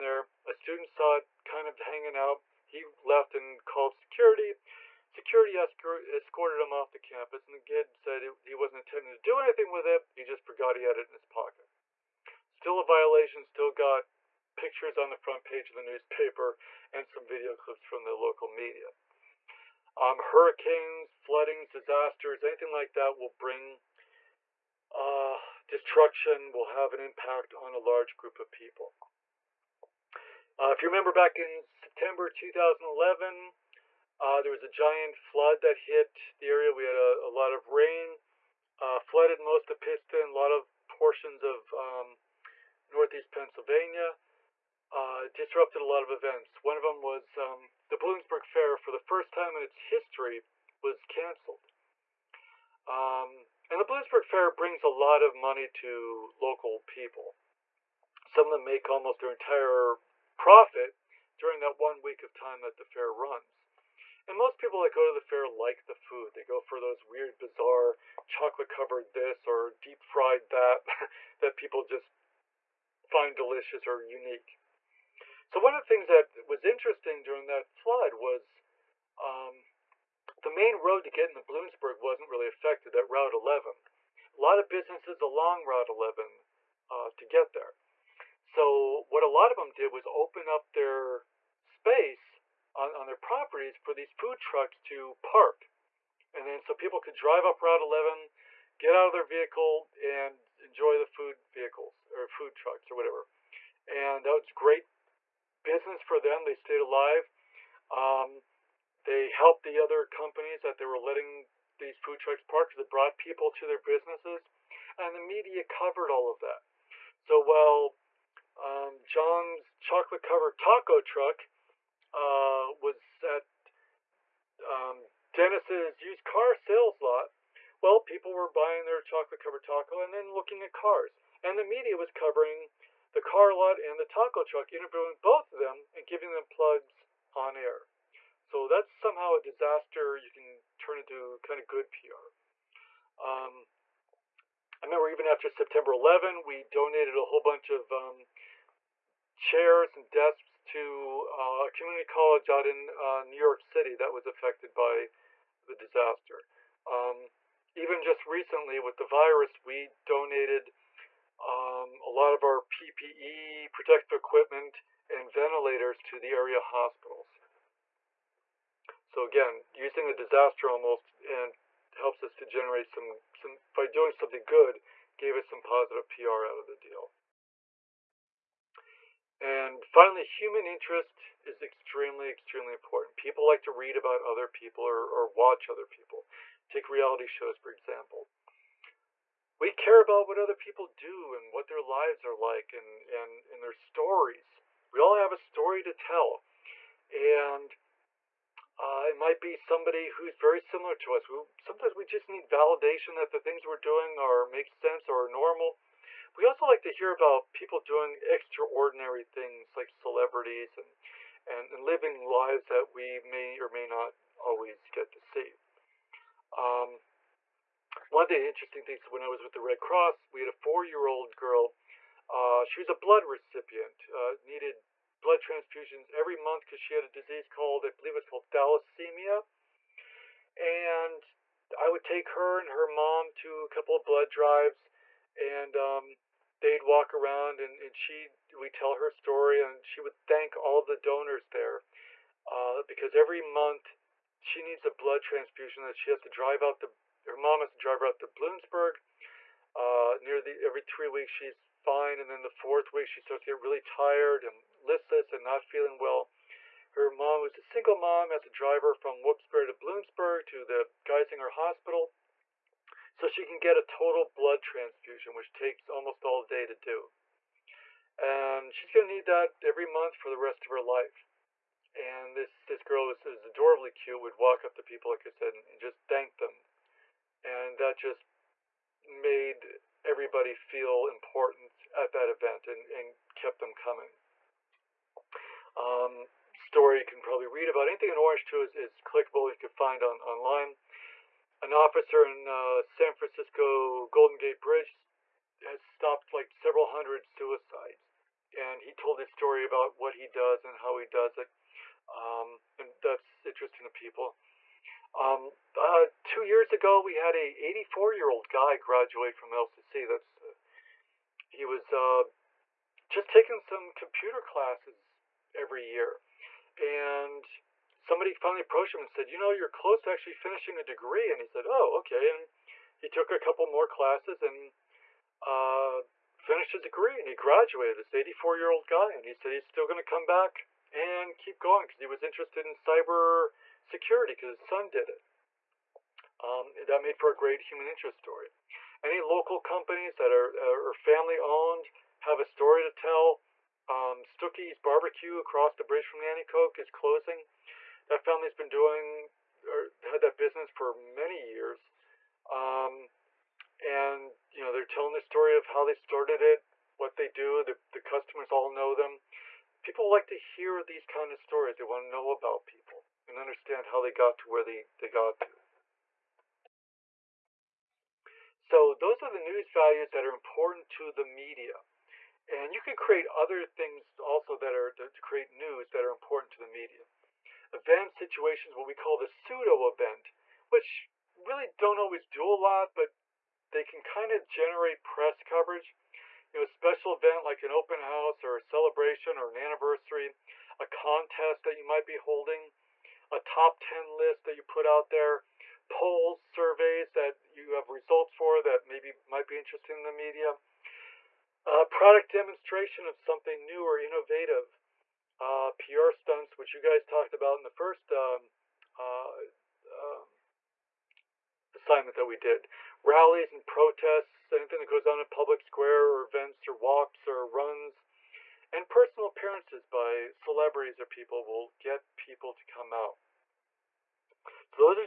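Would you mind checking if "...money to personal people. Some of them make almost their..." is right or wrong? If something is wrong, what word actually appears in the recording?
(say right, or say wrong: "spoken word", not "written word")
wrong: "local", not "personal".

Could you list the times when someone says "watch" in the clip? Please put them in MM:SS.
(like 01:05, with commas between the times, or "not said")
03:05.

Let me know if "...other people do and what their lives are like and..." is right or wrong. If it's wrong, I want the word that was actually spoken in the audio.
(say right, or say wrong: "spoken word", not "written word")
right.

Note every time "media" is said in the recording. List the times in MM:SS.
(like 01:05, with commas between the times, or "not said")
00:18, 01:55, 02:11, 06:11, 06:16, 06:40.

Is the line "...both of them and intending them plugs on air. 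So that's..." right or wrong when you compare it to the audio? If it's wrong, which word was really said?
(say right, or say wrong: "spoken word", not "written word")
wrong: "giving", not "intending".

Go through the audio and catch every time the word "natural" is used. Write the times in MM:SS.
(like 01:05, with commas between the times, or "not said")
not said.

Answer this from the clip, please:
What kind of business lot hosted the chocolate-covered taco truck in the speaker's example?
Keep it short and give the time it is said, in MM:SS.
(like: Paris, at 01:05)
used car sales lot, at 02:06.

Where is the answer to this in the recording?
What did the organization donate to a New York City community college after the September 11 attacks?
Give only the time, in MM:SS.
02:29.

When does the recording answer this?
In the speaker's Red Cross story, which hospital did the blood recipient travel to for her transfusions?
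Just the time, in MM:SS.
04:21.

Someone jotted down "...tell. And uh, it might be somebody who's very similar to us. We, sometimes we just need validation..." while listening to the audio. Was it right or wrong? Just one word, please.
right.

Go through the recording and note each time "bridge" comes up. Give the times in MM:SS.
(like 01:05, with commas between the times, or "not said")
04:54, 05:45.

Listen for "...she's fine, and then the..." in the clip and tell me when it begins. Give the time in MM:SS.
04:11.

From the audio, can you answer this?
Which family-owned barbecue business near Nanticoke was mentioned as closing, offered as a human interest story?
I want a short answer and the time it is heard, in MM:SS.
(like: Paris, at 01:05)
Stookey's Barbecue, at 05:44.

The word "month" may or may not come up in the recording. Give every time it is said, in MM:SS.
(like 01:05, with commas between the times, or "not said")
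03:46, 04:03, 04:29.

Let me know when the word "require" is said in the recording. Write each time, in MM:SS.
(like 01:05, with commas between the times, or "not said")
not said.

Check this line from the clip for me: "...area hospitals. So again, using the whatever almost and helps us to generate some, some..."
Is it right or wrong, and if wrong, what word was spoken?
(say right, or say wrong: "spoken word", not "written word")
wrong: "disaster", not "whatever".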